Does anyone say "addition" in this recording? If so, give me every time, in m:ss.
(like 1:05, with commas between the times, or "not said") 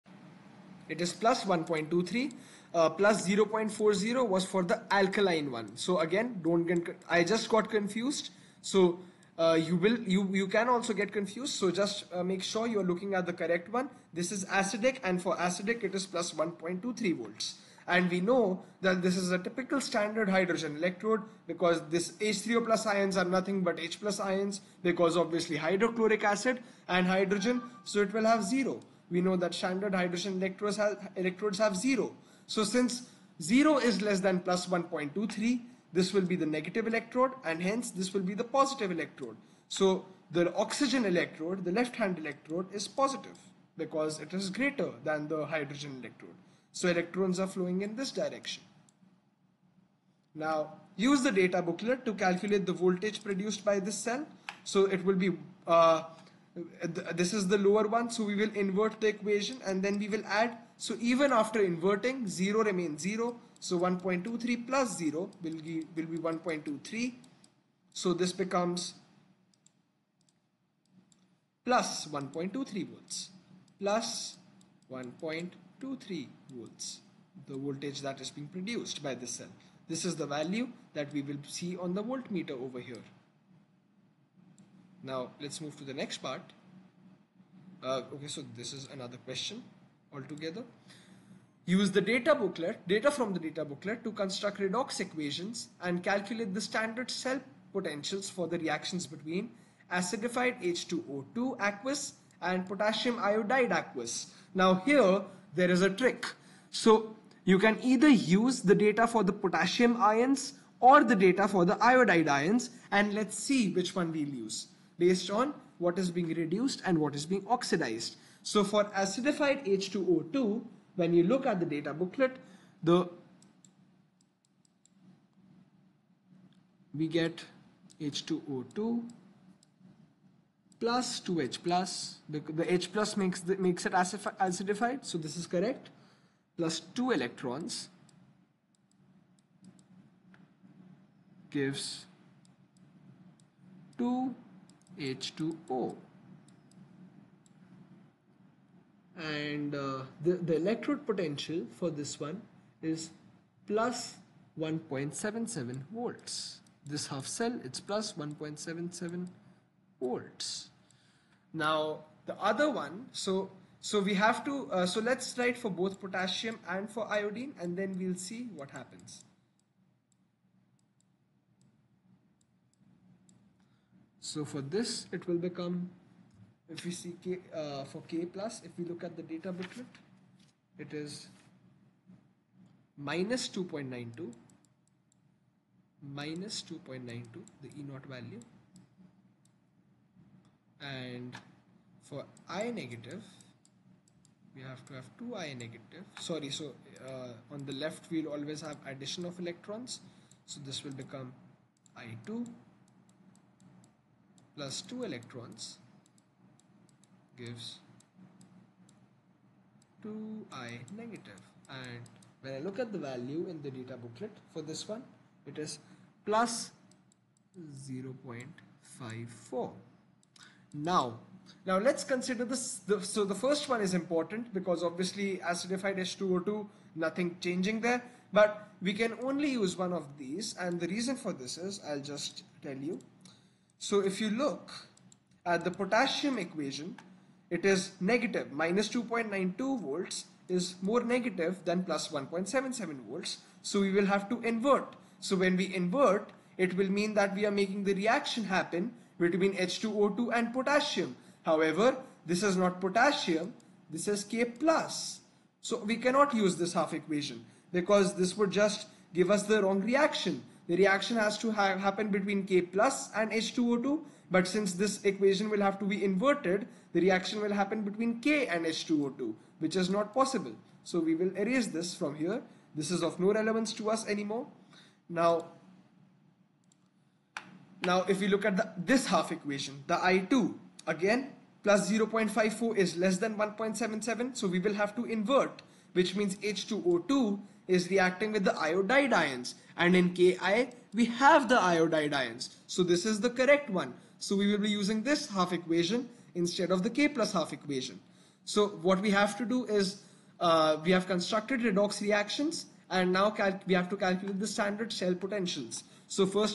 3:18.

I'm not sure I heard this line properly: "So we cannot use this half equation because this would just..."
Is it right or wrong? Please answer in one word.
right.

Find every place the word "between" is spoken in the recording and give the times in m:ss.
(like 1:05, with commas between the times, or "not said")
1:39, 4:09, 4:22, 4:27.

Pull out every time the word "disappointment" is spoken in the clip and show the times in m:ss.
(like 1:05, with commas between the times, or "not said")
not said.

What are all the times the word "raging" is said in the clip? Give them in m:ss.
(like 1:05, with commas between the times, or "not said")
not said.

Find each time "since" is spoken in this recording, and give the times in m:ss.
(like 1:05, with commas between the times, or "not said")
0:32, 4:24.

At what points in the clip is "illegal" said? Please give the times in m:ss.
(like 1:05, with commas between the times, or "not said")
not said.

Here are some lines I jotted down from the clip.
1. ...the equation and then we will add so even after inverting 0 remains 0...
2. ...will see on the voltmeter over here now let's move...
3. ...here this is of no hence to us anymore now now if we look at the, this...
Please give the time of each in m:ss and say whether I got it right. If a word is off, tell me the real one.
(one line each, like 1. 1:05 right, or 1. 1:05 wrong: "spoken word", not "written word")
1. 0:58 right
2. 1:21 right
3. 4:32 wrong: "relevance", not "hence".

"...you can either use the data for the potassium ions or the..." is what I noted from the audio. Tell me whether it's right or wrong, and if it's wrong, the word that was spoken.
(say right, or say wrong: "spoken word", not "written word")
right.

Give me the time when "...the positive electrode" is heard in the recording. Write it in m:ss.
0:38.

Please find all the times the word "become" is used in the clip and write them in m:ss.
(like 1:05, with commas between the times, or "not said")
1:08, 2:55, 3:20.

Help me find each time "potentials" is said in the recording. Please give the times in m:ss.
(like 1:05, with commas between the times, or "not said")
1:37, 2:31, 5:05.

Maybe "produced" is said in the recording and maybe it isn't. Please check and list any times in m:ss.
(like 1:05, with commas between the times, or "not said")
0:53, 1:18.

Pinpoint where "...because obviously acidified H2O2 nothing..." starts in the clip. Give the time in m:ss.
3:44.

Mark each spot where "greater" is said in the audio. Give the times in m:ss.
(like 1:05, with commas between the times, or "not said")
0:44.